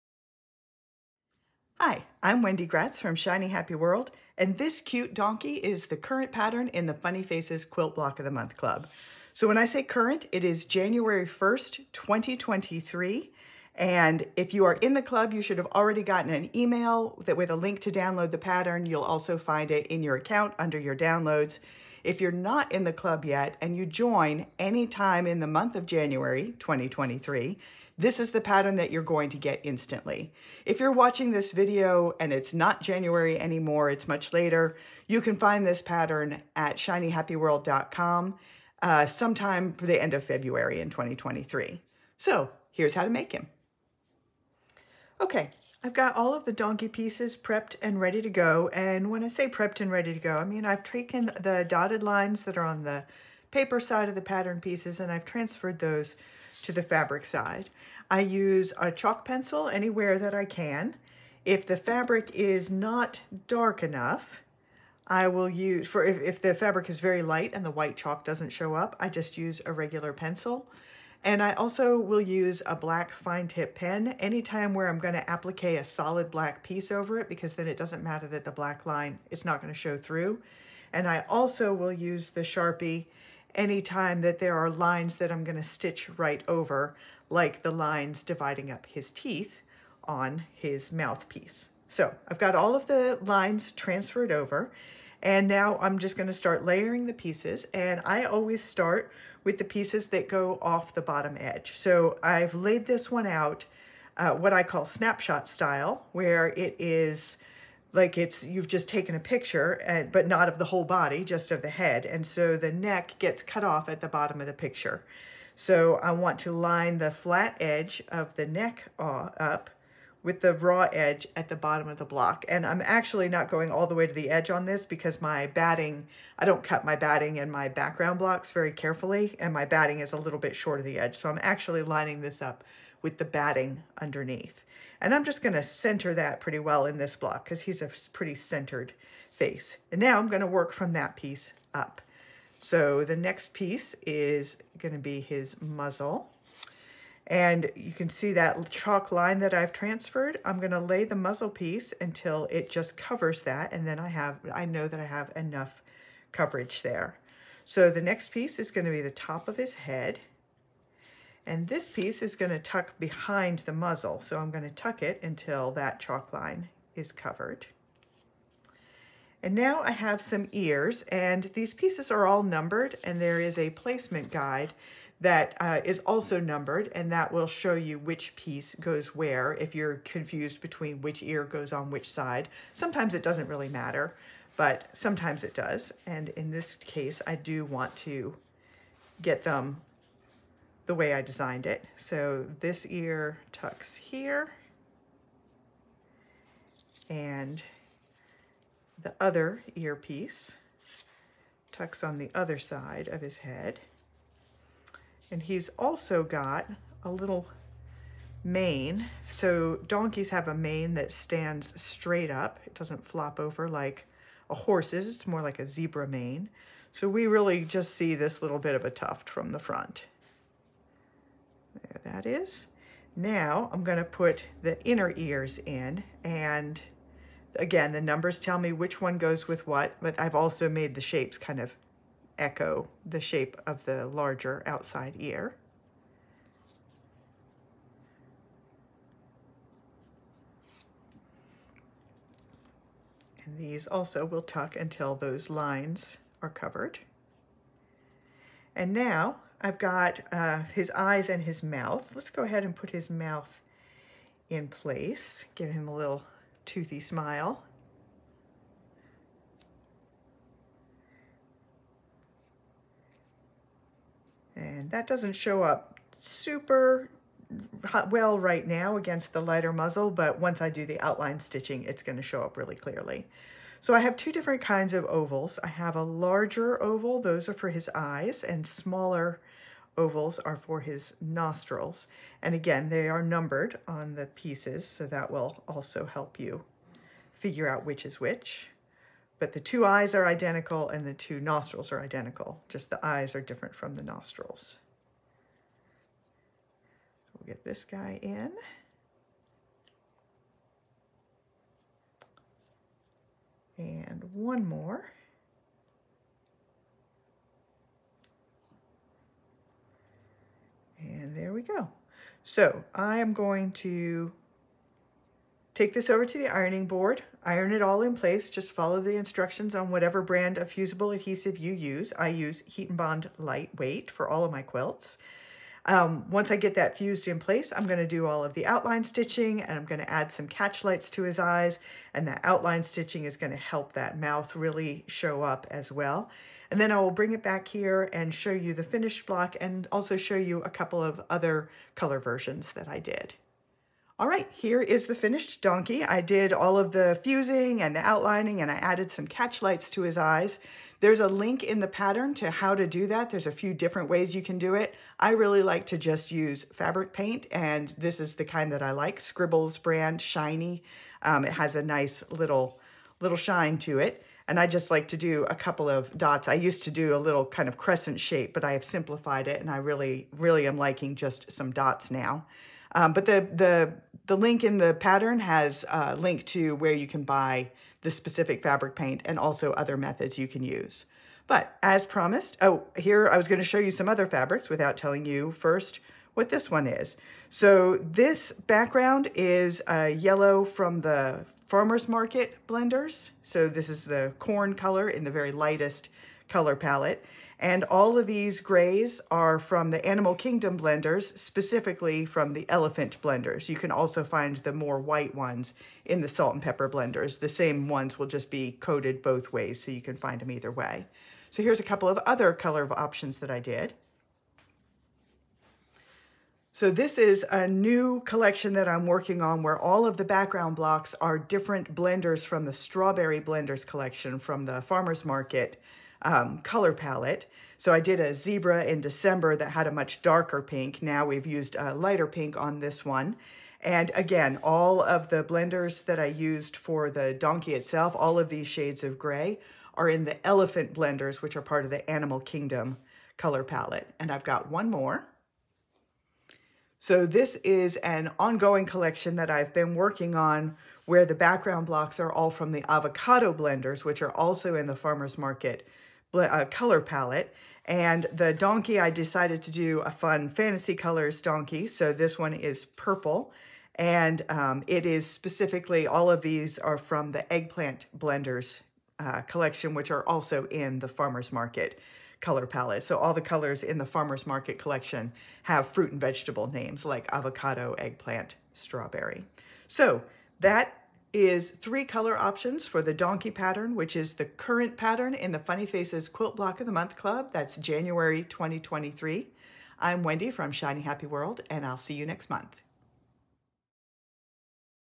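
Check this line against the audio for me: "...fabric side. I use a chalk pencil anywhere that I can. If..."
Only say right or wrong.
right.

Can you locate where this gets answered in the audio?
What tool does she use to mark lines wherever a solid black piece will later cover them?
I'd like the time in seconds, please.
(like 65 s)
72 s.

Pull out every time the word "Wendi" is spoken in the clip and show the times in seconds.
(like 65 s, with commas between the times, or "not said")
2 s, 490 s.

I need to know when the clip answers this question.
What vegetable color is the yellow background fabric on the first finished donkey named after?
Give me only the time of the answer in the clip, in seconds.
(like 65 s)
394 s.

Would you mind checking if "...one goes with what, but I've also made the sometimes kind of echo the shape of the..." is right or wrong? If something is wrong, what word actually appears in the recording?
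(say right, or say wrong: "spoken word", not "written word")
wrong: "shapes", not "sometimes".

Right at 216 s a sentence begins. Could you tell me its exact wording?
So we really just see this little bit of a tuft from the front.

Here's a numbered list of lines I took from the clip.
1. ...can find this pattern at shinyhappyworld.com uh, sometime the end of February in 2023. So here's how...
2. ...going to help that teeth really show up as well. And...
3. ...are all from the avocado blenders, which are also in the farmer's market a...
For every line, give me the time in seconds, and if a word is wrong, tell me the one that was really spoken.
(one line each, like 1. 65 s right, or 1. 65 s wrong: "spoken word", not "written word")
1. 35 s right
2. 333 s wrong: "mouth", not "teeth"
3. 452 s right.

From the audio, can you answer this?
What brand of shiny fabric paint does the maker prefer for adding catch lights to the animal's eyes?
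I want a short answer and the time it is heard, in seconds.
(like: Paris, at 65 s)
Scribbles, at 359 s.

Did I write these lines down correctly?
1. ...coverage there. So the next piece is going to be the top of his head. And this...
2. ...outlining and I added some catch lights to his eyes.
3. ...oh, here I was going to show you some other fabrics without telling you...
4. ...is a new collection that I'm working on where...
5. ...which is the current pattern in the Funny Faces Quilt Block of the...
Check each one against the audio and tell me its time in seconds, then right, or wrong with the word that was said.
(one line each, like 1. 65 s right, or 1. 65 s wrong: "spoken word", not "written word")
1. 156 s right
2. 348 s right
3. 382 s right
4. 417 s right
5. 483 s right.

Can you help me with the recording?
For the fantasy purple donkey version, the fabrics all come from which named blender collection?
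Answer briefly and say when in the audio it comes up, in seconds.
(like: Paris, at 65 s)
Eggplant Blenders, at 467 s.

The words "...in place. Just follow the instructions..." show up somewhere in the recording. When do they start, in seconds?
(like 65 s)
318 s.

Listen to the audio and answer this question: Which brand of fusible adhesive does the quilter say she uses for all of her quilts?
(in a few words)
Heat and Bond Lightweight.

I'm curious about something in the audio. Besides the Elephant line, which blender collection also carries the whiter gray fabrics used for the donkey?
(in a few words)
Salt and Pepper.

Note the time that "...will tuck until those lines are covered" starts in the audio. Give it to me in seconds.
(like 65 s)
244 s.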